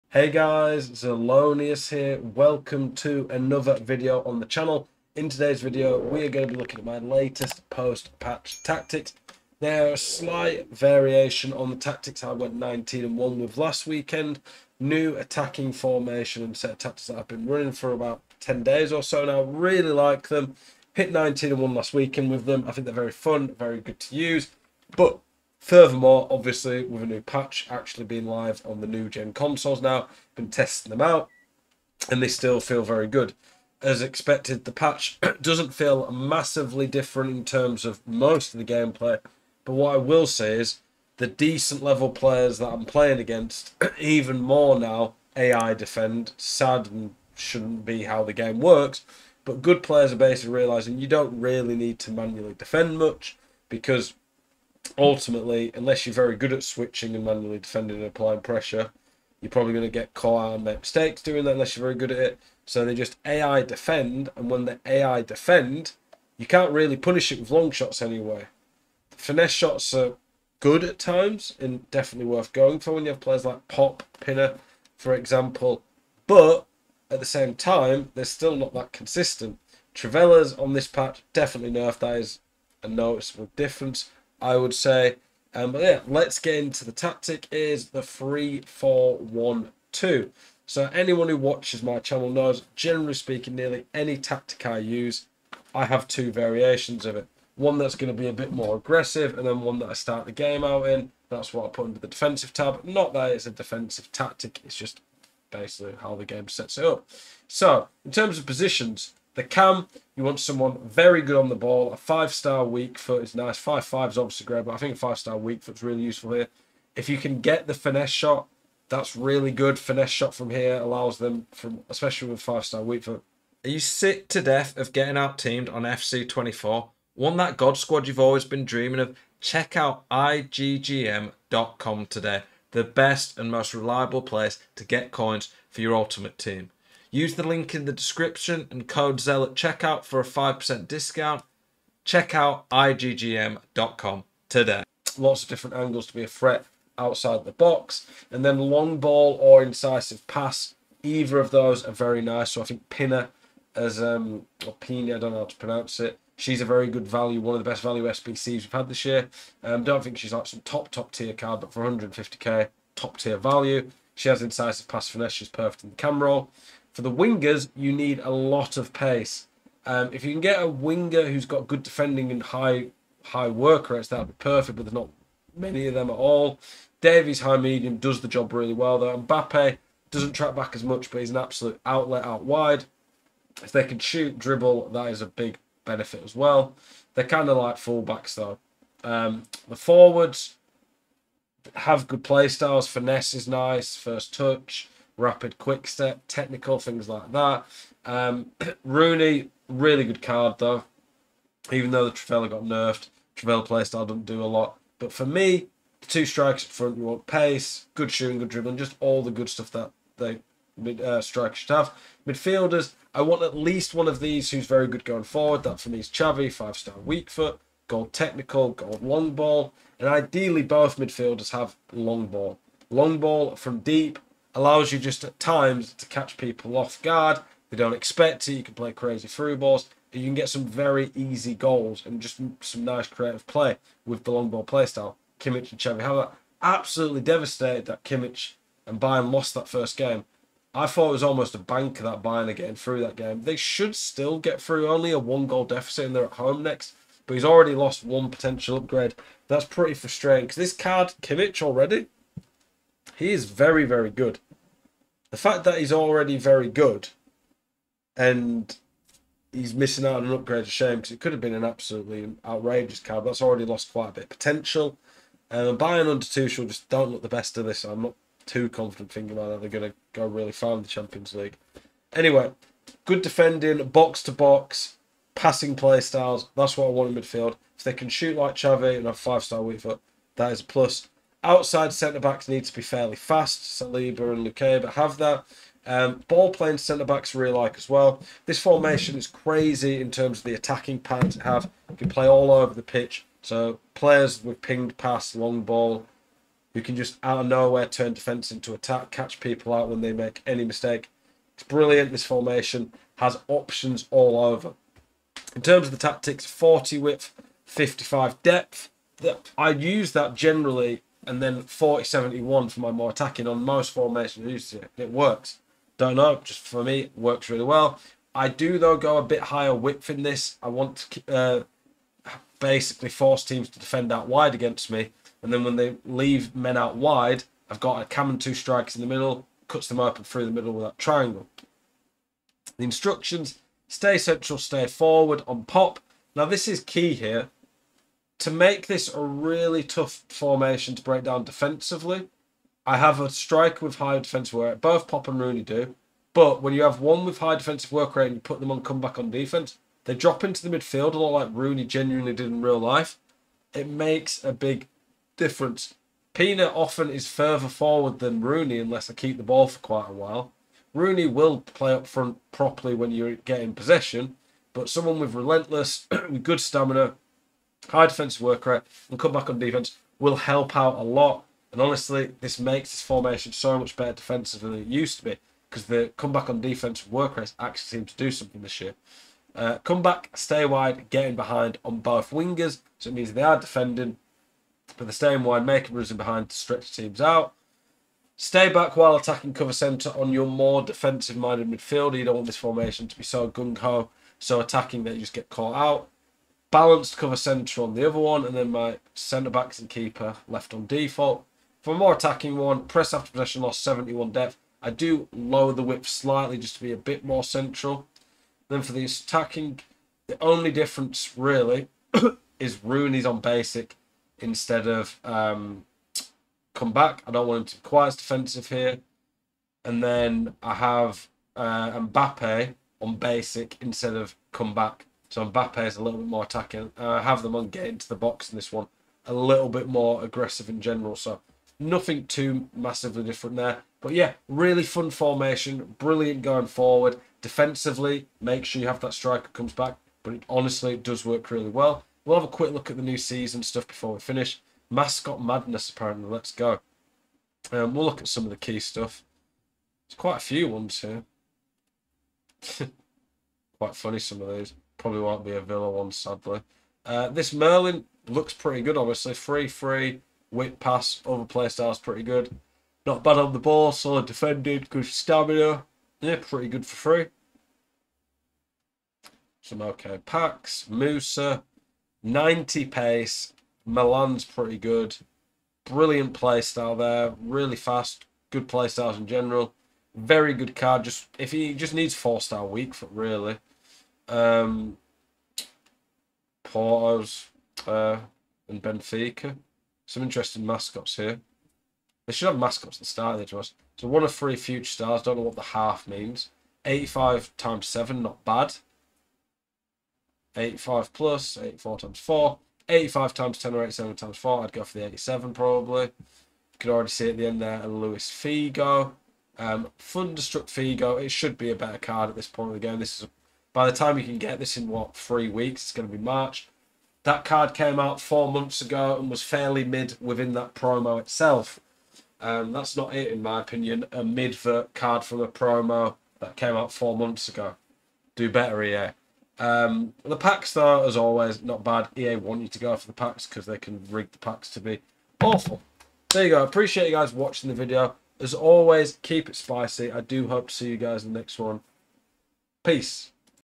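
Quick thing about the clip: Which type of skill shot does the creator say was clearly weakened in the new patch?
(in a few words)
Trivelas.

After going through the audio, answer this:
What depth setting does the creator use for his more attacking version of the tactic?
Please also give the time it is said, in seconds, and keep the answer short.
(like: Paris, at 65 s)
71, at 403 s.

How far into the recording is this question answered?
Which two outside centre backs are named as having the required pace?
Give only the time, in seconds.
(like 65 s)
283 s.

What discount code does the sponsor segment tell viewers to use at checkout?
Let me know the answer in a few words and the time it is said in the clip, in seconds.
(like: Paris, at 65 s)
ZEL, at 139 s.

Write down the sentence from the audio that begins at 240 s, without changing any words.
I thought it was almost a bank that Bayern are getting through that game.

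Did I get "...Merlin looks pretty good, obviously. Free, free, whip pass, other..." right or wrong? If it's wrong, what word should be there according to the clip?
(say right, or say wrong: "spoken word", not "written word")
right.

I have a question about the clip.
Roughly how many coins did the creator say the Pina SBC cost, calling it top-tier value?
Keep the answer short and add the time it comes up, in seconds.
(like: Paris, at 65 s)
150k, at 161 s.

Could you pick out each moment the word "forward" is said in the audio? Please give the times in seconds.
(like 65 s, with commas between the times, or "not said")
189 s, 215 s, 334 s, 357 s, 436 s.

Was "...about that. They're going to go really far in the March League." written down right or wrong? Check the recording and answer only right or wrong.
wrong.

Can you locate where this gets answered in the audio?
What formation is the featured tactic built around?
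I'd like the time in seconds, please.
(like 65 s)
88 s.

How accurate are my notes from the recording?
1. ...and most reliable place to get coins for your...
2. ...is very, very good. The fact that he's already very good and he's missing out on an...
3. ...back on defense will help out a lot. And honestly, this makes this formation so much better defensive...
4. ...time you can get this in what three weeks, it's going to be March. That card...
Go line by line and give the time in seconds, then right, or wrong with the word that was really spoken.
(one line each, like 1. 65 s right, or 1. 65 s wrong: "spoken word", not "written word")
1. 133 s right
2. 253 s right
3. 369 s right
4. 513 s right.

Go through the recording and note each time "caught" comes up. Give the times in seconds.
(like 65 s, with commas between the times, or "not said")
60 s, 395 s.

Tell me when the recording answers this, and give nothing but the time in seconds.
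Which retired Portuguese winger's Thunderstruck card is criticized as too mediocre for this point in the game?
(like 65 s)
507 s.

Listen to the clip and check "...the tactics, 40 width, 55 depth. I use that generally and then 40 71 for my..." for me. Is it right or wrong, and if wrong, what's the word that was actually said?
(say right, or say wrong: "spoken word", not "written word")
right.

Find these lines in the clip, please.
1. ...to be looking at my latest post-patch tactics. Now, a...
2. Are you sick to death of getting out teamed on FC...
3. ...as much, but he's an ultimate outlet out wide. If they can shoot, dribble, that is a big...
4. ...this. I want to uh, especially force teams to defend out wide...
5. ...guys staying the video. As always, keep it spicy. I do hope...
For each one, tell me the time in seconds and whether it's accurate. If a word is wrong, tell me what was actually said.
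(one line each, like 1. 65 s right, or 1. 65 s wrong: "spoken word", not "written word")
1. 6 s right
2. 123 s right
3. 180 s wrong: "absolute", not "ultimate"
4. 320 s wrong: "basically", not "especially"
5. 537 s wrong: "watching", not "staying".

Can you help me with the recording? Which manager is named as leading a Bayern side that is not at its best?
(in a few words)
Tuchel.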